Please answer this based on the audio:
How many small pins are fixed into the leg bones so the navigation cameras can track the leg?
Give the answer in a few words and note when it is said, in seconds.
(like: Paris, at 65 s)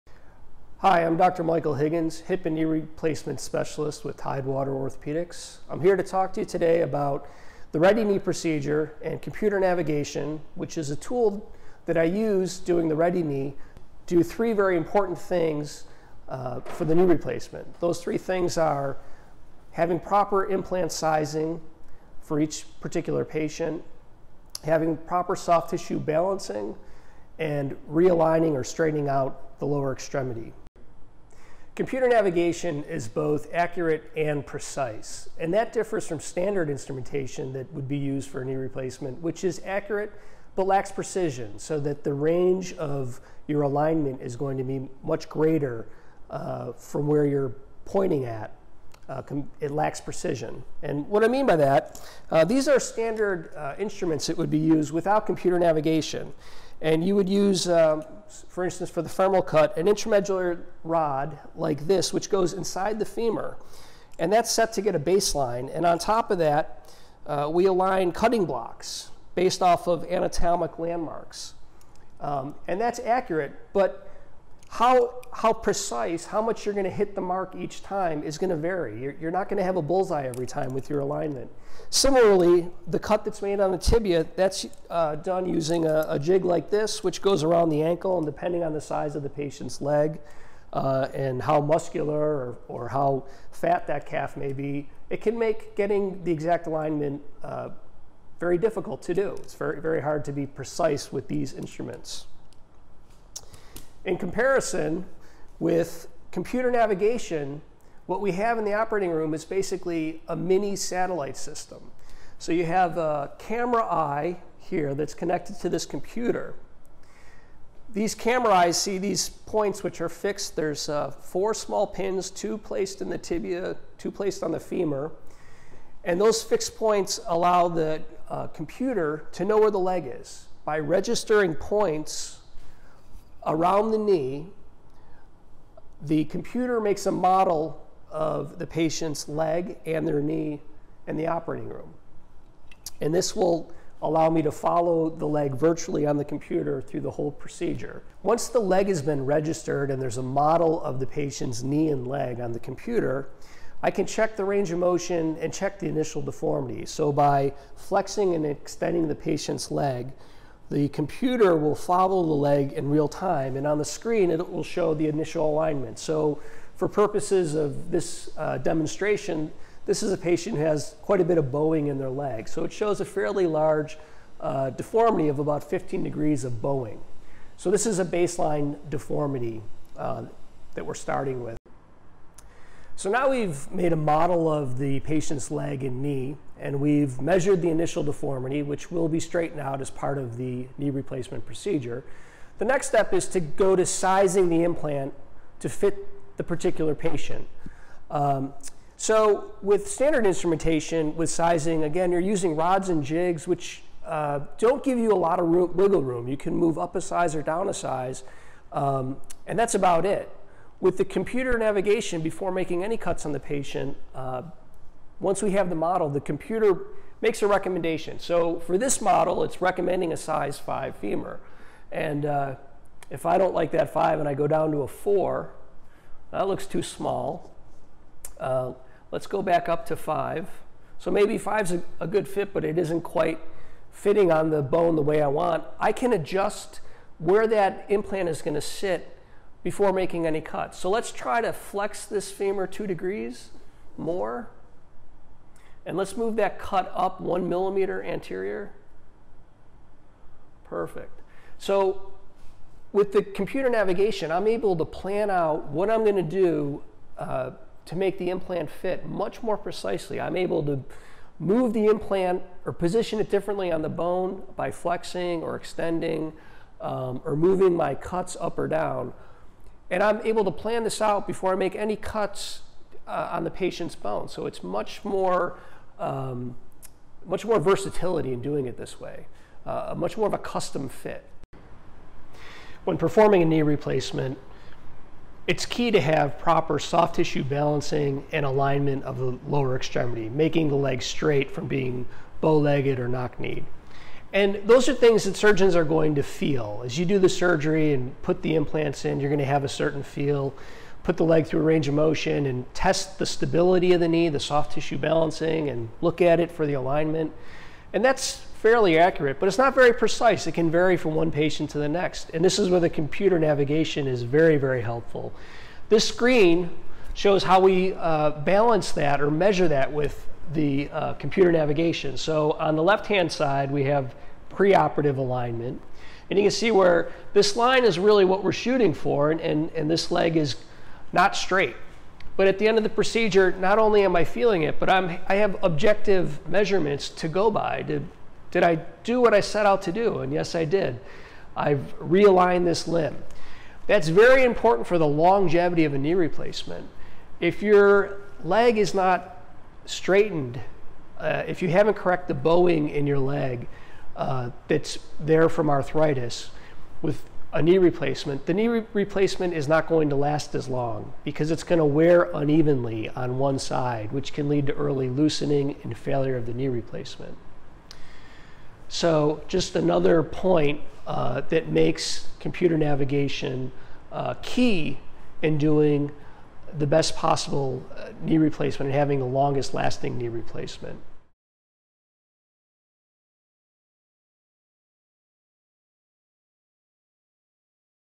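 4, at 121 s.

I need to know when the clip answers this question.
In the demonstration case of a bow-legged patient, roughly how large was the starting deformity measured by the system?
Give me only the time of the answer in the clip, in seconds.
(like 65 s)
175 s.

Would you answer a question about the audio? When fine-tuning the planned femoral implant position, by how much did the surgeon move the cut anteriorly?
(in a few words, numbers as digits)
1 millimeter.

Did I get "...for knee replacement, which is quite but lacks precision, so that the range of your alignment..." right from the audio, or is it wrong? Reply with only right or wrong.
wrong.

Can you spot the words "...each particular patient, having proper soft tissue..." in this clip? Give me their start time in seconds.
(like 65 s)
22 s.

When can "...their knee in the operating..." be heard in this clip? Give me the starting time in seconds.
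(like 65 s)
140 s.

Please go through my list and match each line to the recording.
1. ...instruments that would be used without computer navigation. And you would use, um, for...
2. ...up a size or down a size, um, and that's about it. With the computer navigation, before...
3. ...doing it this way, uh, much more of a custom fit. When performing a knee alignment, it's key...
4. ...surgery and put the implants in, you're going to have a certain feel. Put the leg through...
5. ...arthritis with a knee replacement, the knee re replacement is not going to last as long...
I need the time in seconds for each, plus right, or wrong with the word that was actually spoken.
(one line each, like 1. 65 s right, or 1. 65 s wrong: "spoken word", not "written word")
1. 53 s right
2. 206 s right
3. 278 s wrong: "replacement", not "alignment"
4. 297 s right
5. 355 s right.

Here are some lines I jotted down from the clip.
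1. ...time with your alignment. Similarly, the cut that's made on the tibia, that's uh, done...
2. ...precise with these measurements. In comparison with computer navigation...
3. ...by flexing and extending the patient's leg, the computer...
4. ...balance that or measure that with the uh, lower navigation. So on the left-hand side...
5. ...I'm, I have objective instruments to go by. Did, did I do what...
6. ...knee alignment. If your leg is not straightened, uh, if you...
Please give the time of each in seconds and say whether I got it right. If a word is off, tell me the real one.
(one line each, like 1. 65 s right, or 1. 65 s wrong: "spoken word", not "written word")
1. 80 s right
2. 100 s wrong: "instruments", not "measurements"
3. 157 s right
4. 318 s wrong: "computer", not "lower"
5. 334 s wrong: "measurements", not "instruments"
6. 345 s wrong: "replacement", not "alignment".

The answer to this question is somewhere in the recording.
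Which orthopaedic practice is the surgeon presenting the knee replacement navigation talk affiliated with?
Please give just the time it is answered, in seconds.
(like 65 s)
4 s.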